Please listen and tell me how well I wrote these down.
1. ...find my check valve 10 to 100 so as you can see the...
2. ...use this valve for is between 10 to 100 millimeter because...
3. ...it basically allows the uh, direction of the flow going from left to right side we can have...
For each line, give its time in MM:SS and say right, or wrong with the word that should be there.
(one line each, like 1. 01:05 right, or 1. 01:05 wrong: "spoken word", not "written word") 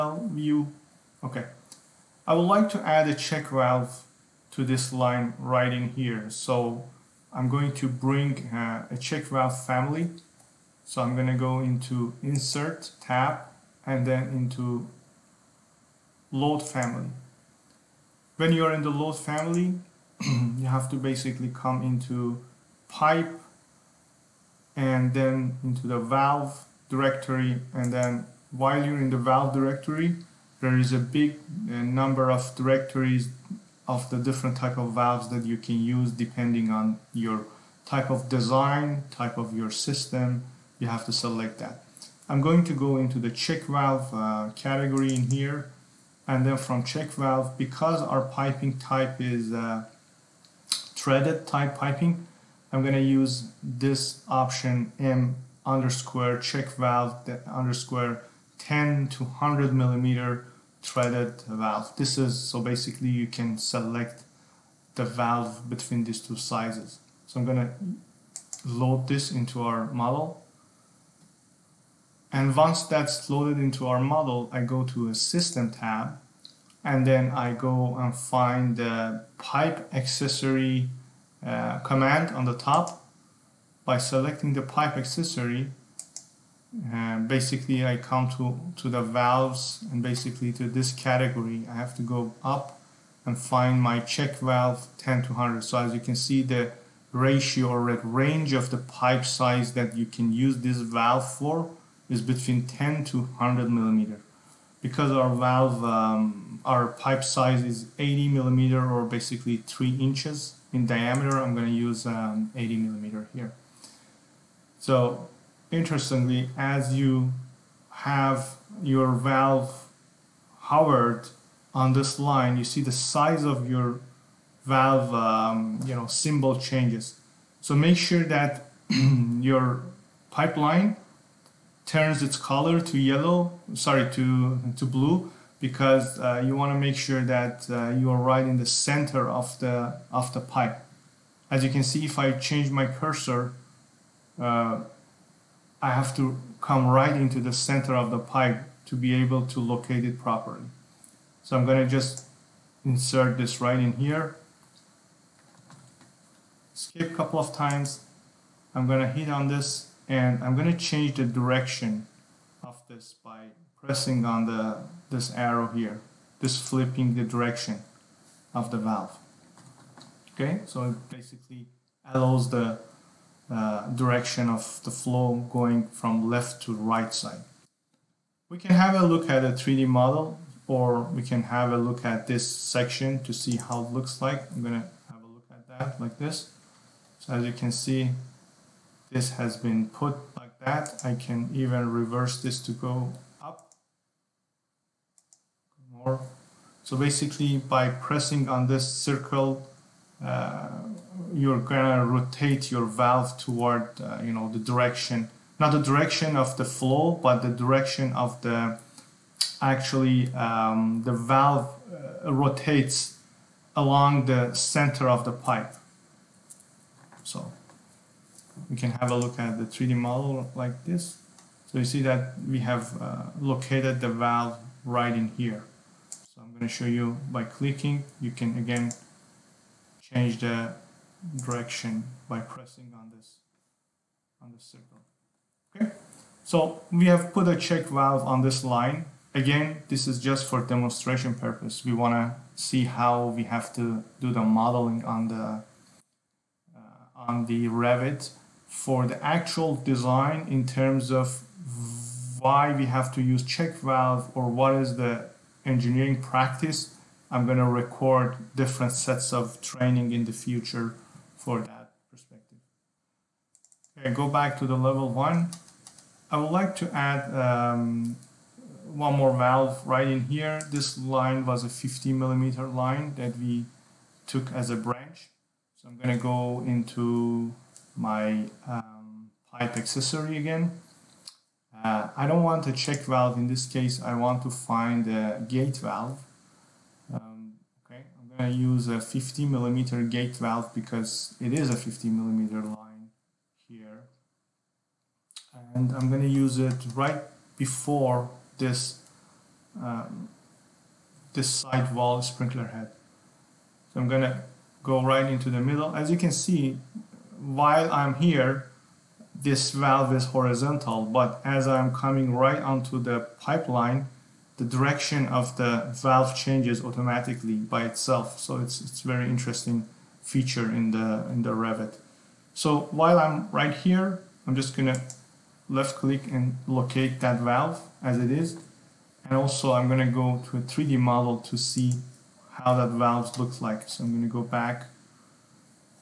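1. 01:33 right
2. 01:40 right
3. 02:50 right.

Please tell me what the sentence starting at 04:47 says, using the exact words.
Um, okay, I'm going to use a 50 millimeter gate valve because it is a 50 millimeter line here.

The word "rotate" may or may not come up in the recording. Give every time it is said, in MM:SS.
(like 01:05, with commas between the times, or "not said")
03:22, 03:32.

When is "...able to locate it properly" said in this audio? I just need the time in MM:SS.
02:29.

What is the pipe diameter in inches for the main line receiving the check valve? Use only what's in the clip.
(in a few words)
3 inches.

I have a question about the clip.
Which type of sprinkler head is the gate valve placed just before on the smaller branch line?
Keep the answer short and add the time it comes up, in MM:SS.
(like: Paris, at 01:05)
Side wall, at 05:01.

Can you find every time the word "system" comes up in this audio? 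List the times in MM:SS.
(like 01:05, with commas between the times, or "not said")
00:39, 01:15.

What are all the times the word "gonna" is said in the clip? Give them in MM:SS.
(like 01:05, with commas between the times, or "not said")
03:04, 03:21, 05:24, 05:29, 05:34.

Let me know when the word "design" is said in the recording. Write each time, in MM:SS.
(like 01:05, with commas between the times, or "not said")
00:38, 04:09.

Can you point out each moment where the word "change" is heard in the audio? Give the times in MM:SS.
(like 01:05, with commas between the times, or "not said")
02:06, 02:22, 02:40, 03:50, 05:16.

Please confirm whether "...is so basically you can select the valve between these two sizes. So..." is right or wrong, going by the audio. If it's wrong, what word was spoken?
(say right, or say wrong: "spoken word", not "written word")
right.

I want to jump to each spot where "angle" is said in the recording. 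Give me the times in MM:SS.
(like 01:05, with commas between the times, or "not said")
not said.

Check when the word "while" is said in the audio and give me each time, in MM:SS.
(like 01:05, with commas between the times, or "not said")
00:28, 05:07, 05:22.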